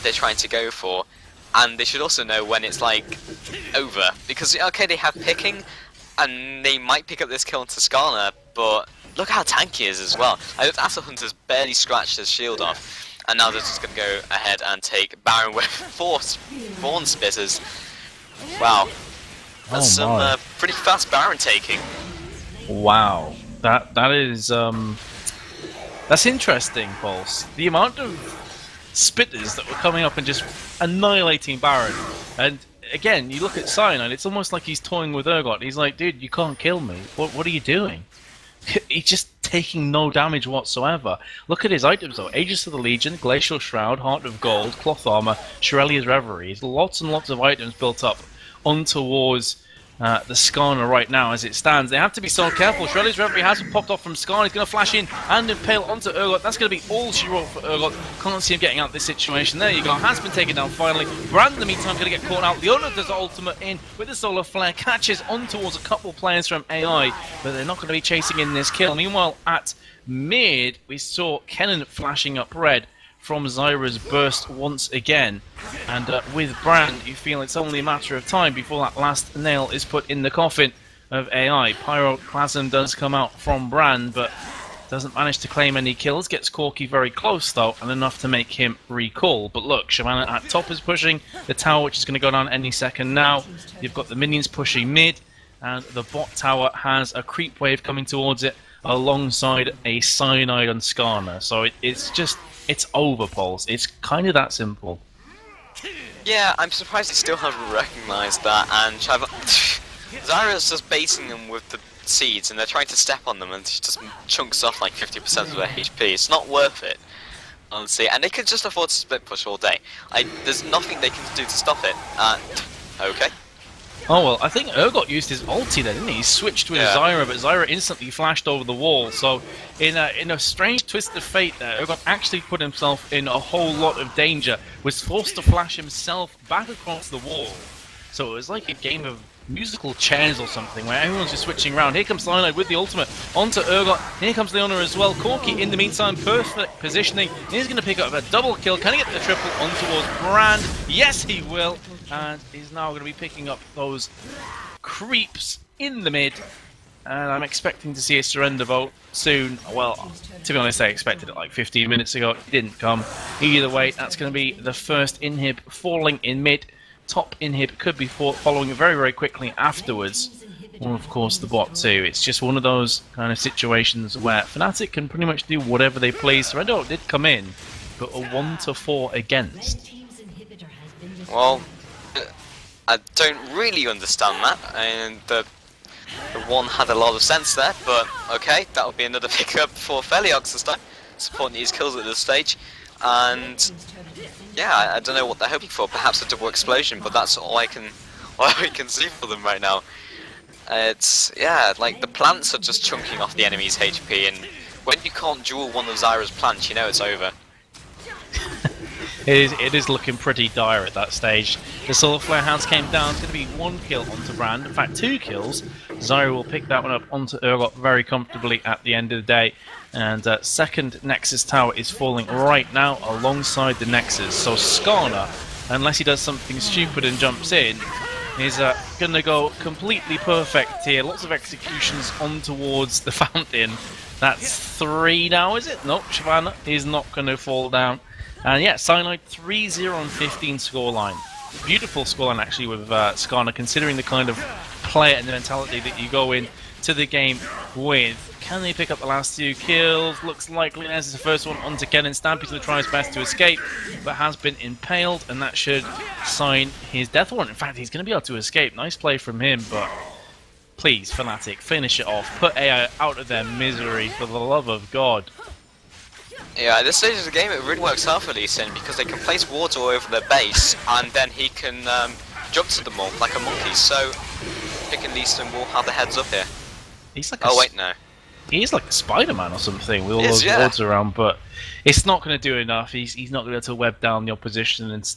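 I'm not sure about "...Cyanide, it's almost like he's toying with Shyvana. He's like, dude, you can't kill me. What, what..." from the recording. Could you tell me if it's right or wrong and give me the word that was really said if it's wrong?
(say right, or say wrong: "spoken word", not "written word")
wrong: "Urgot", not "Shyvana".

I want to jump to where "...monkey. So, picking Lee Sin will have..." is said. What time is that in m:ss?
4:33.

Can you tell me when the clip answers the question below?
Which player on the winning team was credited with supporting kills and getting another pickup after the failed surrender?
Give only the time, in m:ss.
3:10.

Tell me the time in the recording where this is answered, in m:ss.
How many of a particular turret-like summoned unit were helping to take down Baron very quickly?
0:15.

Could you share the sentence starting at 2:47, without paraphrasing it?
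Top inhib could be following very, very quickly afterwards.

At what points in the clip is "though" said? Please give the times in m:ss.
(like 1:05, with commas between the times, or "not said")
0:42, 1:27.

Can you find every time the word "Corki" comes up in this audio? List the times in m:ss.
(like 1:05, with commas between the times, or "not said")
1:26, 2:25.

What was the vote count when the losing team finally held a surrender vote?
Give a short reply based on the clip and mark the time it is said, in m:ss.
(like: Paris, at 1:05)
1 to 4, at 2:58.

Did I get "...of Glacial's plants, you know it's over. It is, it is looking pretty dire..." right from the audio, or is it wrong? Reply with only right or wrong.
wrong.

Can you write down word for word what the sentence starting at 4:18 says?
Nice play from him, but please, Fnatic, finish it off.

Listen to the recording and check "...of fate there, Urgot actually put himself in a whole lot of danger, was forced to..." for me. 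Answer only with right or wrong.
right.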